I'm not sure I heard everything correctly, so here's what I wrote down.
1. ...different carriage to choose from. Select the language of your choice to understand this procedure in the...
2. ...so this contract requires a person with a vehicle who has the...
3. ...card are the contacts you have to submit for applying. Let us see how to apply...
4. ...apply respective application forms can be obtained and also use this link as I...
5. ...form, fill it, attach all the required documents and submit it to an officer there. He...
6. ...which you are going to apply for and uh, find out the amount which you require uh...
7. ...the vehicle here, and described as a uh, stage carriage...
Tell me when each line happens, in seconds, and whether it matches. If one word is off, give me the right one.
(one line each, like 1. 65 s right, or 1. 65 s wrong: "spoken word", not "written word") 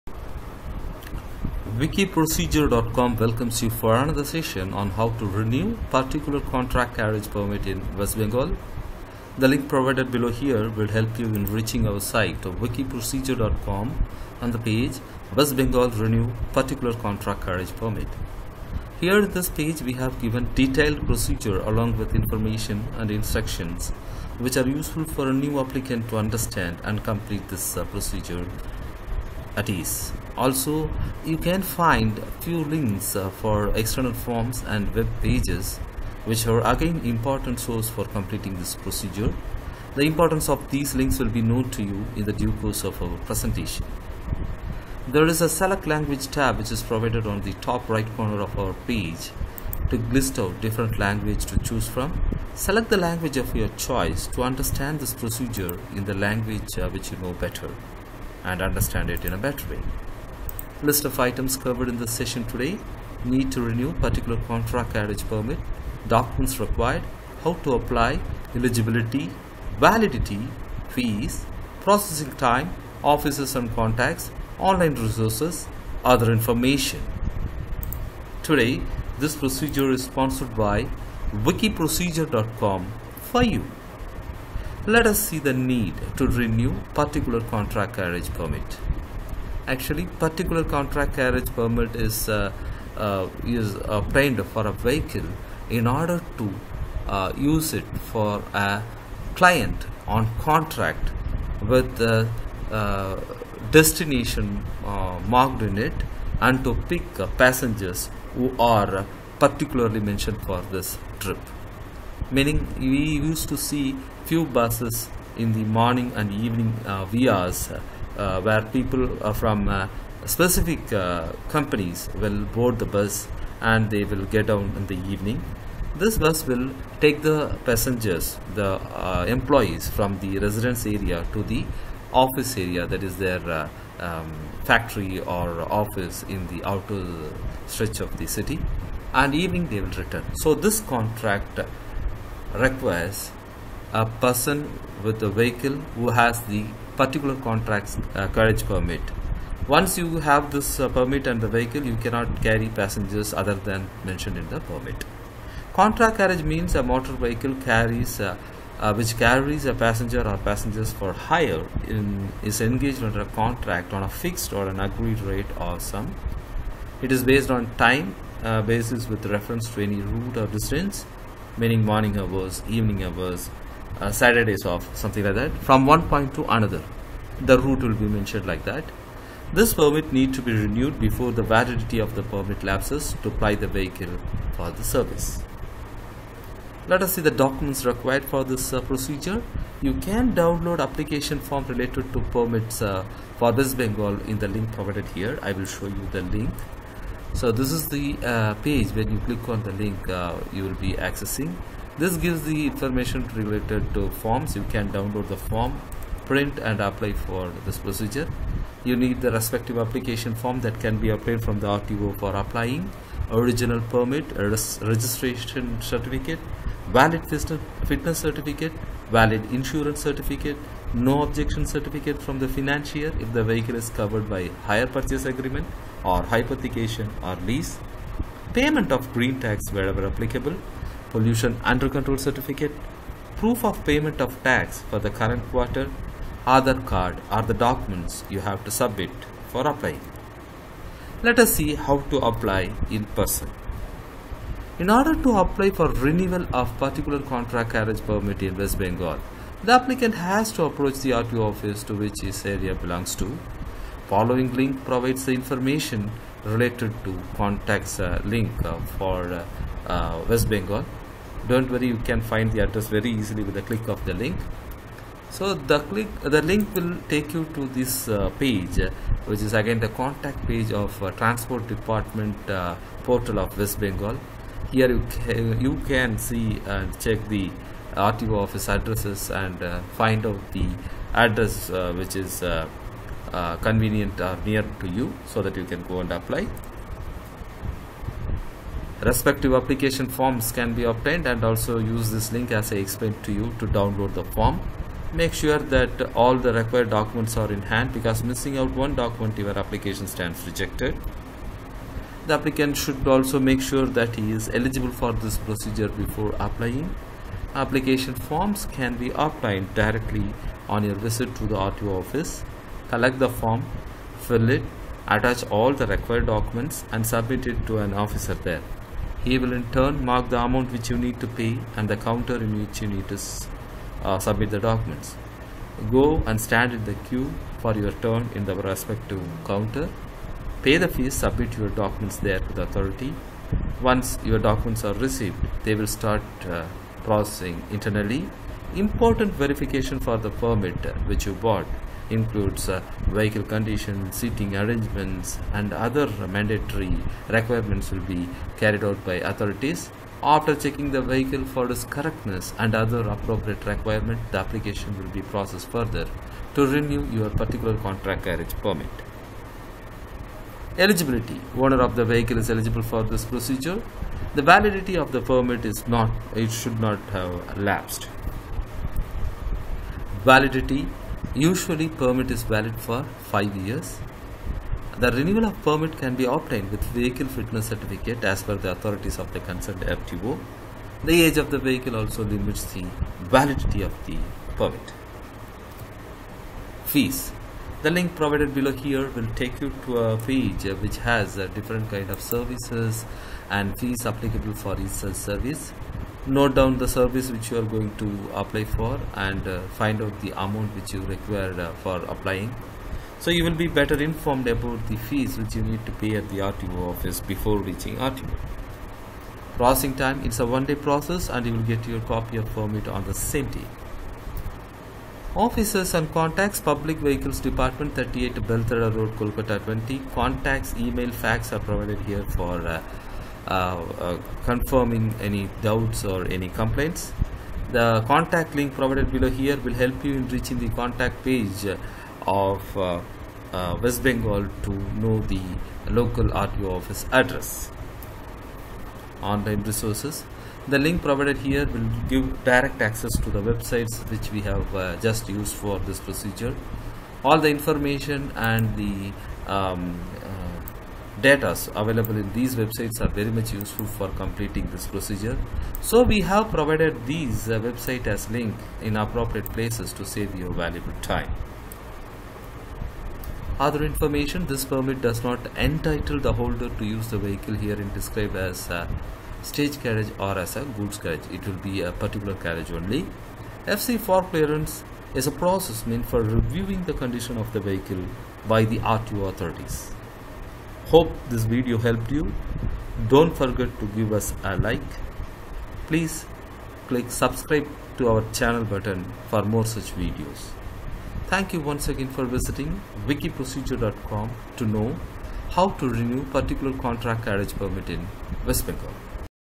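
1. 50 s wrong: "language", not "carriage"
2. 140 s right
3. 236 s wrong: "documents", not "contacts"
4. 286 s right
5. 313 s right
6. 397 s right
7. 467 s right.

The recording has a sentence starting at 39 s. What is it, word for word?
The importance of these links will be known to you in the due course of our presentation.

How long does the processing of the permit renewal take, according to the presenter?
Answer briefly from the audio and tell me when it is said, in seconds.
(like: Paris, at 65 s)
One day, at 410 s.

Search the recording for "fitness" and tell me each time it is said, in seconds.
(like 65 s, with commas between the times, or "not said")
217 s, 377 s.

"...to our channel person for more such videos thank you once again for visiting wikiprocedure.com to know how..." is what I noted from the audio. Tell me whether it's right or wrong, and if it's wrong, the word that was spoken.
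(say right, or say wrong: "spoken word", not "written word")
wrong: "button", not "person".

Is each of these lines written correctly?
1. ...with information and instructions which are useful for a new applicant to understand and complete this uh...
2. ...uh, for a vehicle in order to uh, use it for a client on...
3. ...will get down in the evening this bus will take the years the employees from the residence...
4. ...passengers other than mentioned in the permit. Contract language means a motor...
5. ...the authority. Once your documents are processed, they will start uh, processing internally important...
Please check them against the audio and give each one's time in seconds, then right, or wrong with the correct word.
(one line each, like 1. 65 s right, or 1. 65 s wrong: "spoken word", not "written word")
1. 21 s right
2. 94 s right
3. 124 s wrong: "passengers", not "years"
4. 152 s wrong: "carriage", not "language"
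5. 332 s wrong: "received", not "processed".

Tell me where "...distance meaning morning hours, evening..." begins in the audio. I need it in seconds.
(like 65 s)
170 s.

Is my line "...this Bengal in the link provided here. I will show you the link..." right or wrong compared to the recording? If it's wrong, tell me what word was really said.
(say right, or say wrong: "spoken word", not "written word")
right.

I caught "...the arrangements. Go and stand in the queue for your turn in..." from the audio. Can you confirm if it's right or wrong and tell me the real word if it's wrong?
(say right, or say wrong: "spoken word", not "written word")
wrong: "documents", not "arrangements".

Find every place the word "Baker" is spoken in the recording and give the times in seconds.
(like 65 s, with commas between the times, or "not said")
not said.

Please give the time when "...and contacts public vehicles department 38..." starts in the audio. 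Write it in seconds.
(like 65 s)
415 s.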